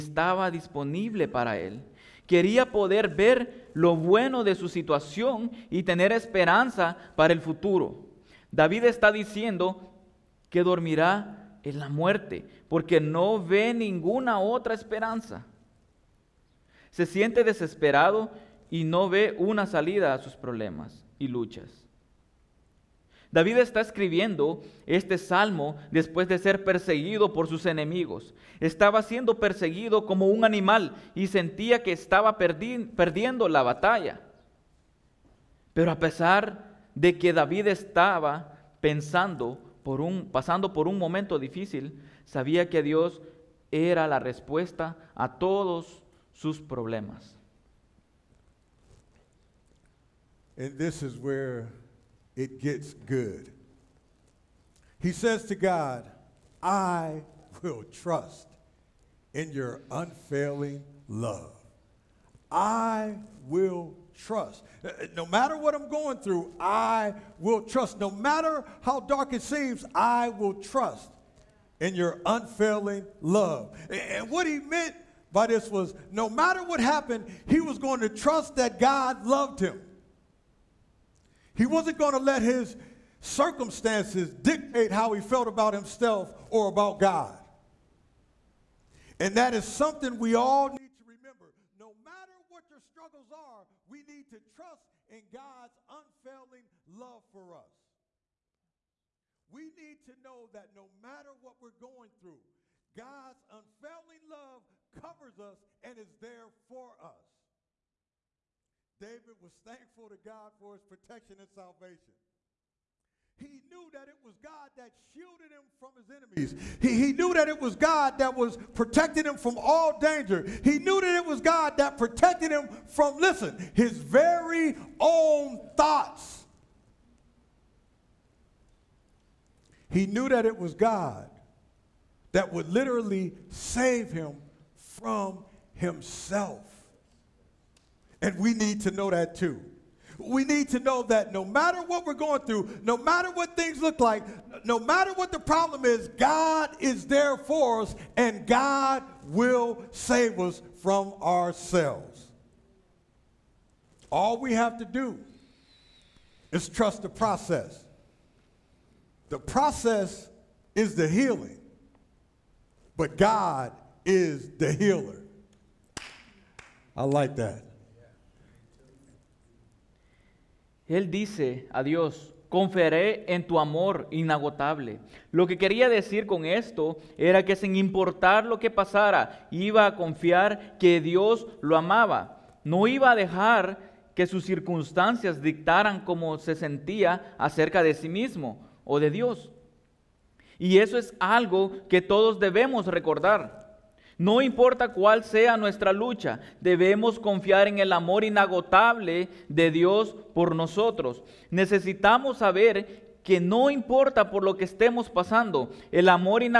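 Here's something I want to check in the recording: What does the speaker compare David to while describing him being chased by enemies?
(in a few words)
un animal.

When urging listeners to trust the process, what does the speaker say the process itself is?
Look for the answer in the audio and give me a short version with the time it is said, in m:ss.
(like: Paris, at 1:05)
the healing, at 2:40.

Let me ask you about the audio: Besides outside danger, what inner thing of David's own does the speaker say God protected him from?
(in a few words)
thoughts.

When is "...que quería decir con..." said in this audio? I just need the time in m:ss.
2:55.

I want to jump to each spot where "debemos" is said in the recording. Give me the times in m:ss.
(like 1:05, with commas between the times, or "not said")
3:12, 3:16.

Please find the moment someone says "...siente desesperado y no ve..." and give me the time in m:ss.
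0:17.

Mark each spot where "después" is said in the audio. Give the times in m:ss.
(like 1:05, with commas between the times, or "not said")
0:25.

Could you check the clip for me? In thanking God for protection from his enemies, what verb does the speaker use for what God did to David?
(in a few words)
shielded.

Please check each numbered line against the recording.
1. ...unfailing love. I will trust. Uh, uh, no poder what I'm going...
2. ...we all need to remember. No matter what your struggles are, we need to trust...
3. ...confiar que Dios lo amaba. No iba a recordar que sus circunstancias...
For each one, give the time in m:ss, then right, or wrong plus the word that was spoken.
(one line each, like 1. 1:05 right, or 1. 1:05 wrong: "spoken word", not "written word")
1. 0:59 wrong: "matter", not "poder"
2. 1:30 right
3. 2:59 wrong: "dejar", not "recordar".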